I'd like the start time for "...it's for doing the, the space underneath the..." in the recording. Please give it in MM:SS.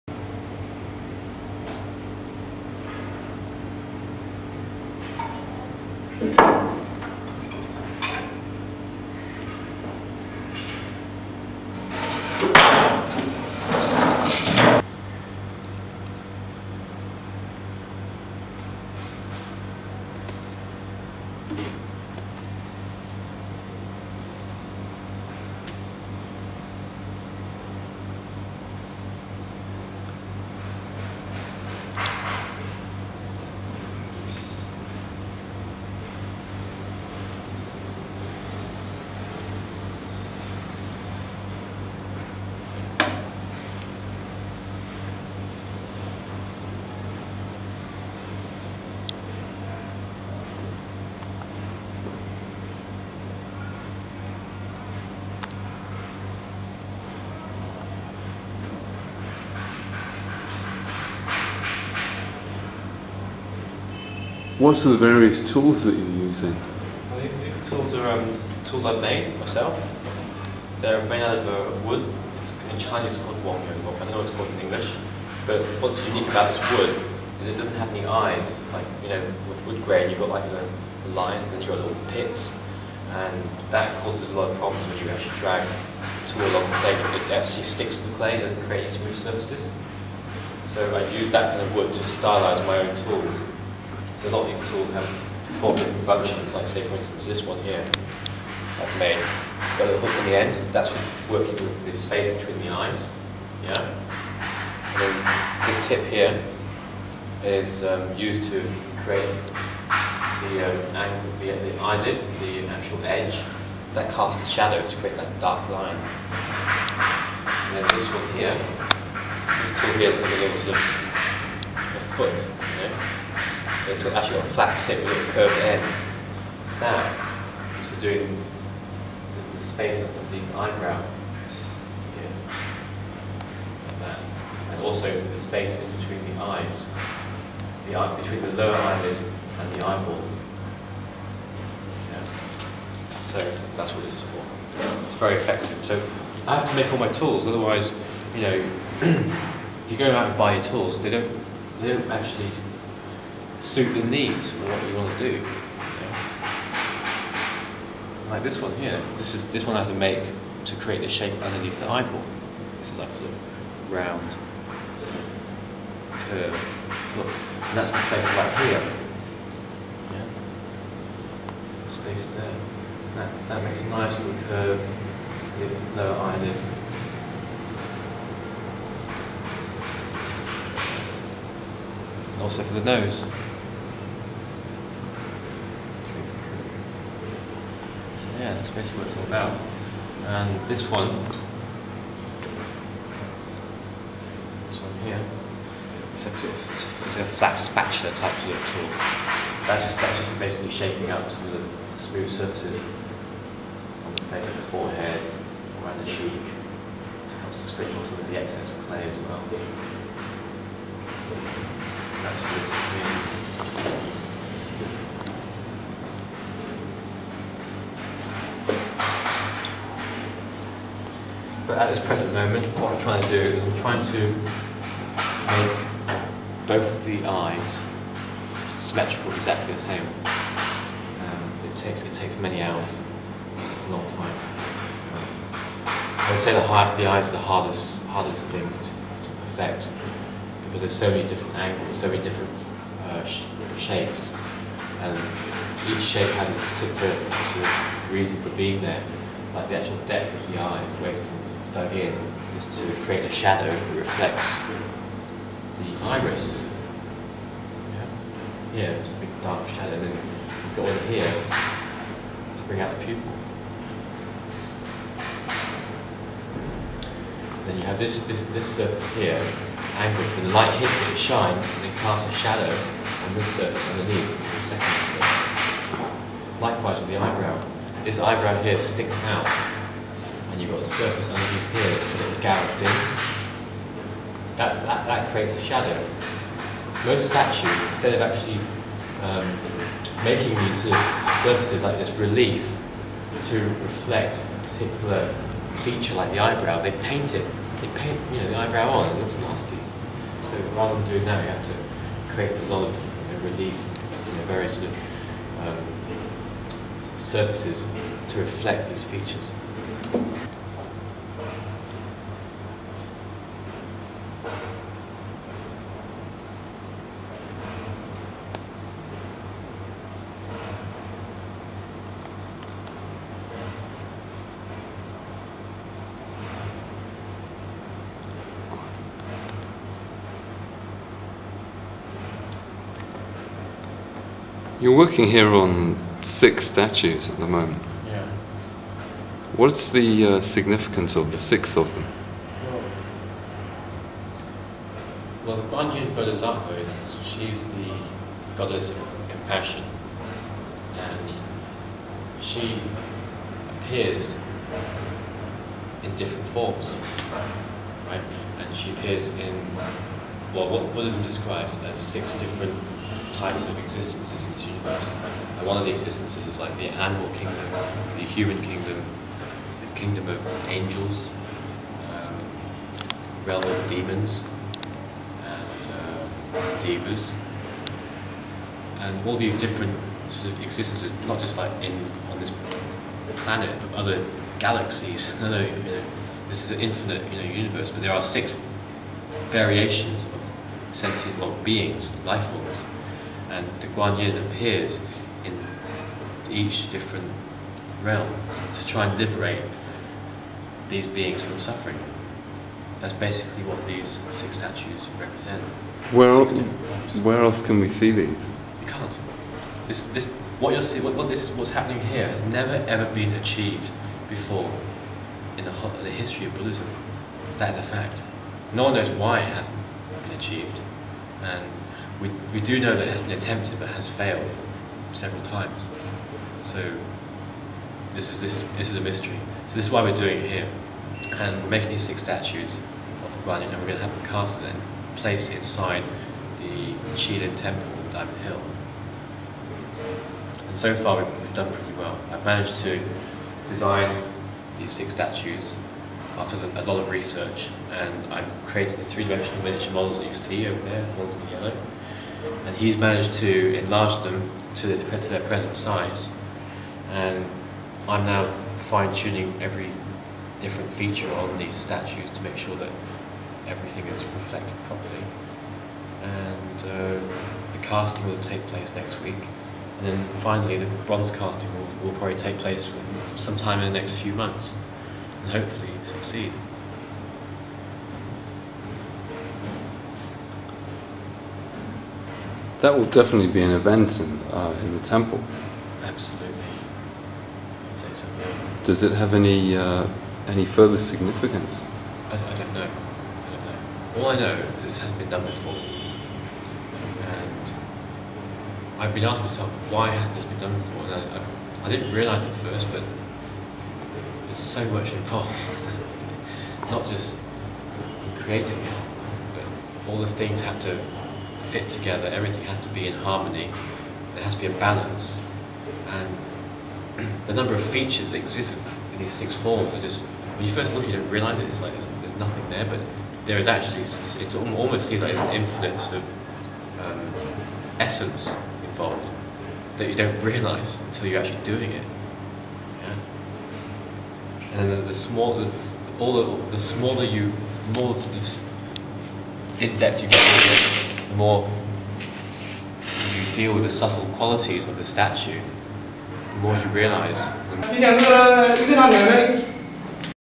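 02:07.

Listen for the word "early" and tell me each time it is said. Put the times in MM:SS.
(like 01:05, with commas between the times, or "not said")
not said.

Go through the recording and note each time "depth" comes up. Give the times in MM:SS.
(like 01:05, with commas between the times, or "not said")
04:10, 08:59.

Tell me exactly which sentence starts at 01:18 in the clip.
Like, you know, with wood grain, you've got like the, the lines and then you've got little pits.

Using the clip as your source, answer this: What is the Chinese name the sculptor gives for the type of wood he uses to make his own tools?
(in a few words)
Yong.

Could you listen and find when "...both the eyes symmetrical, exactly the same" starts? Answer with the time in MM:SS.
03:46.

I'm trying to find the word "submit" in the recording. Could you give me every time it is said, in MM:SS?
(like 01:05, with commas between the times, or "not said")
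not said.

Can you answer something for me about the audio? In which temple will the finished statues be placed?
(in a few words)
Chi Lin Temple.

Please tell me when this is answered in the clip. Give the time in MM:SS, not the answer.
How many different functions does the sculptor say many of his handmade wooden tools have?
01:35.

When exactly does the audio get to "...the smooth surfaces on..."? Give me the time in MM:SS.
03:21.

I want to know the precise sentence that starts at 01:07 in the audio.
Well, these, these tools are um, tools I've made myself.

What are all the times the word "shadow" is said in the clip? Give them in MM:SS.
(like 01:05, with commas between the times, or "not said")
01:54, 04:13, 04:19, 04:32, 04:45.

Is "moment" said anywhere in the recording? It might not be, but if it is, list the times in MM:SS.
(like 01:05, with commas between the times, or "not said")
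03:42, 05:37.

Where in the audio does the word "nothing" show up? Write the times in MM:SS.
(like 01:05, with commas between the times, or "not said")
08:42.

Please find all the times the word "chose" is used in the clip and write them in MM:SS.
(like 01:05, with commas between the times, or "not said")
not said.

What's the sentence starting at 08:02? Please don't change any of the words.
that will definitely be an event in, uh, in the temple.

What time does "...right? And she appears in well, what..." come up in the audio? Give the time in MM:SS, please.
05:58.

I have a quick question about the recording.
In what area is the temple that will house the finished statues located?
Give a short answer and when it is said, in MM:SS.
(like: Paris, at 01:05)
Diamond Hill, at 07:18.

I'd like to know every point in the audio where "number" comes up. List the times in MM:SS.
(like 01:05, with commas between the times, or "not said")
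08:37.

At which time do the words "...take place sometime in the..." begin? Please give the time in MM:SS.
07:52.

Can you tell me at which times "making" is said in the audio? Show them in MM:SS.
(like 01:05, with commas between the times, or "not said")
04:50, 07:11.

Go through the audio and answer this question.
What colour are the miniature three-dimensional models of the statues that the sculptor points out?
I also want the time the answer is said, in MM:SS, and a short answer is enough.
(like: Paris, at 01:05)
Yellow, at 07:31.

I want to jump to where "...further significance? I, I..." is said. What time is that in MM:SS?
08:10.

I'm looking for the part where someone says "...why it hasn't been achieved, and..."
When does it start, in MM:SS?
06:59.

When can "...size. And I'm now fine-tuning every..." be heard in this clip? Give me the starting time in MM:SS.
07:35.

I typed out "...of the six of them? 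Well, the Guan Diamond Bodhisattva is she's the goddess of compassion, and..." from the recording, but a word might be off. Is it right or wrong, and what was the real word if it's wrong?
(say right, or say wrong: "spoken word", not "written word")
wrong: "Yin", not "Diamond".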